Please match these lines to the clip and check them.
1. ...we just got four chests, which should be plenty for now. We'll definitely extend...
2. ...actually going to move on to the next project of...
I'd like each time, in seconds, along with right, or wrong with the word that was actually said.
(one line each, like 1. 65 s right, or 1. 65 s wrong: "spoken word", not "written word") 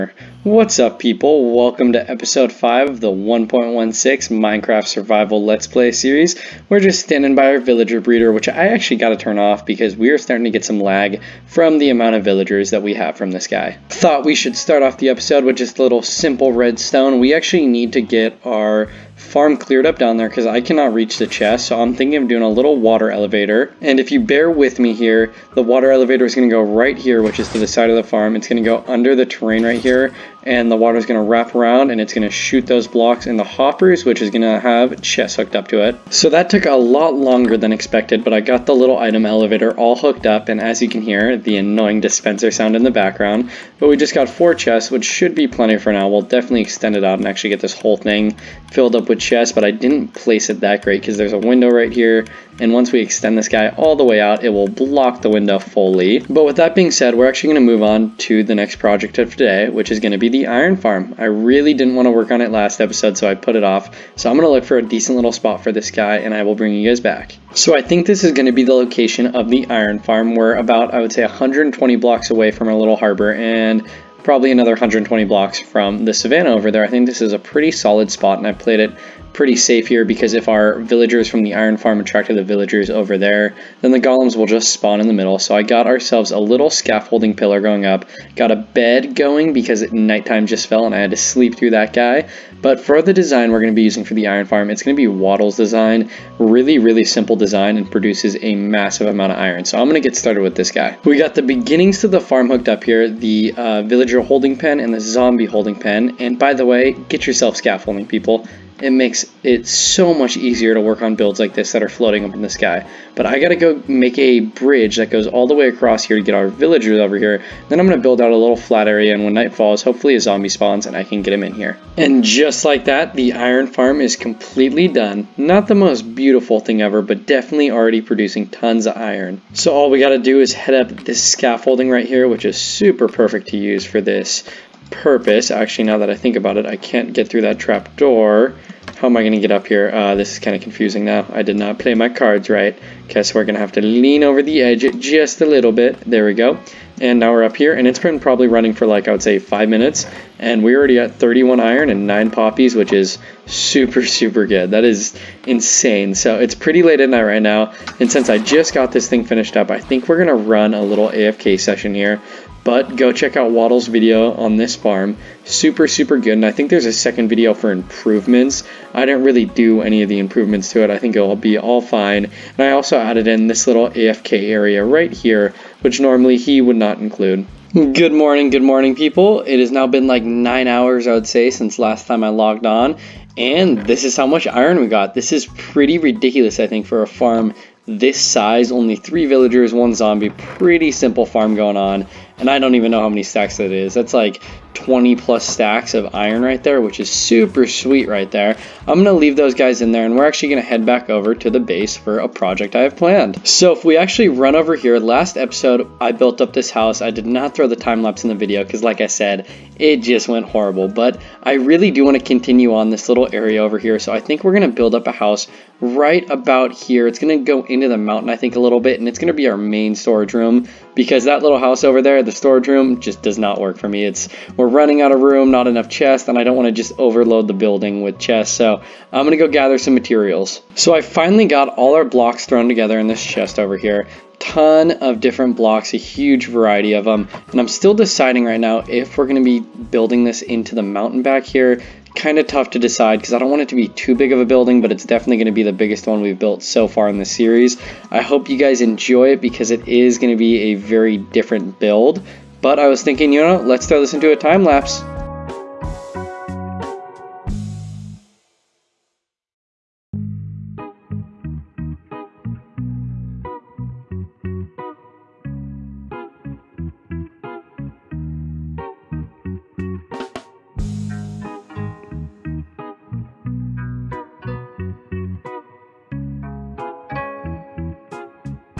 1. 43 s right
2. 57 s right.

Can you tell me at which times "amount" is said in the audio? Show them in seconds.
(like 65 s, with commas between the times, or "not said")
11 s, 99 s.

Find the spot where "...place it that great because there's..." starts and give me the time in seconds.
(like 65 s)
50 s.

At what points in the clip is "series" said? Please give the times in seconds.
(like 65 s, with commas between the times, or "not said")
5 s, 247 s.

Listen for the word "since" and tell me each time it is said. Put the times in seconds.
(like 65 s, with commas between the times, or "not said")
158 s, 181 s.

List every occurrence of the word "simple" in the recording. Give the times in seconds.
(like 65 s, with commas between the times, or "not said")
16 s, 97 s, 190 s.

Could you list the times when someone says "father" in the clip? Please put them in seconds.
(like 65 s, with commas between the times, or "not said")
not said.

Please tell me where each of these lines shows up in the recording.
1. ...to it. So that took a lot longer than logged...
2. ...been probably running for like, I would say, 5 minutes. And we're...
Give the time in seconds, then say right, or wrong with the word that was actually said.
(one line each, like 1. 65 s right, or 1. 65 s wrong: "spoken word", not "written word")
1. 35 s wrong: "expected", not "logged"
2. 147 s right.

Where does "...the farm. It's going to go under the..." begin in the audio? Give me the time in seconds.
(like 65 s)
27 s.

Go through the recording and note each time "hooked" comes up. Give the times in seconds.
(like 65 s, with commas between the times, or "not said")
35 s, 39 s, 102 s.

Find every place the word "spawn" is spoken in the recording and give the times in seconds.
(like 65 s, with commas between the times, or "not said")
84 s, 120 s.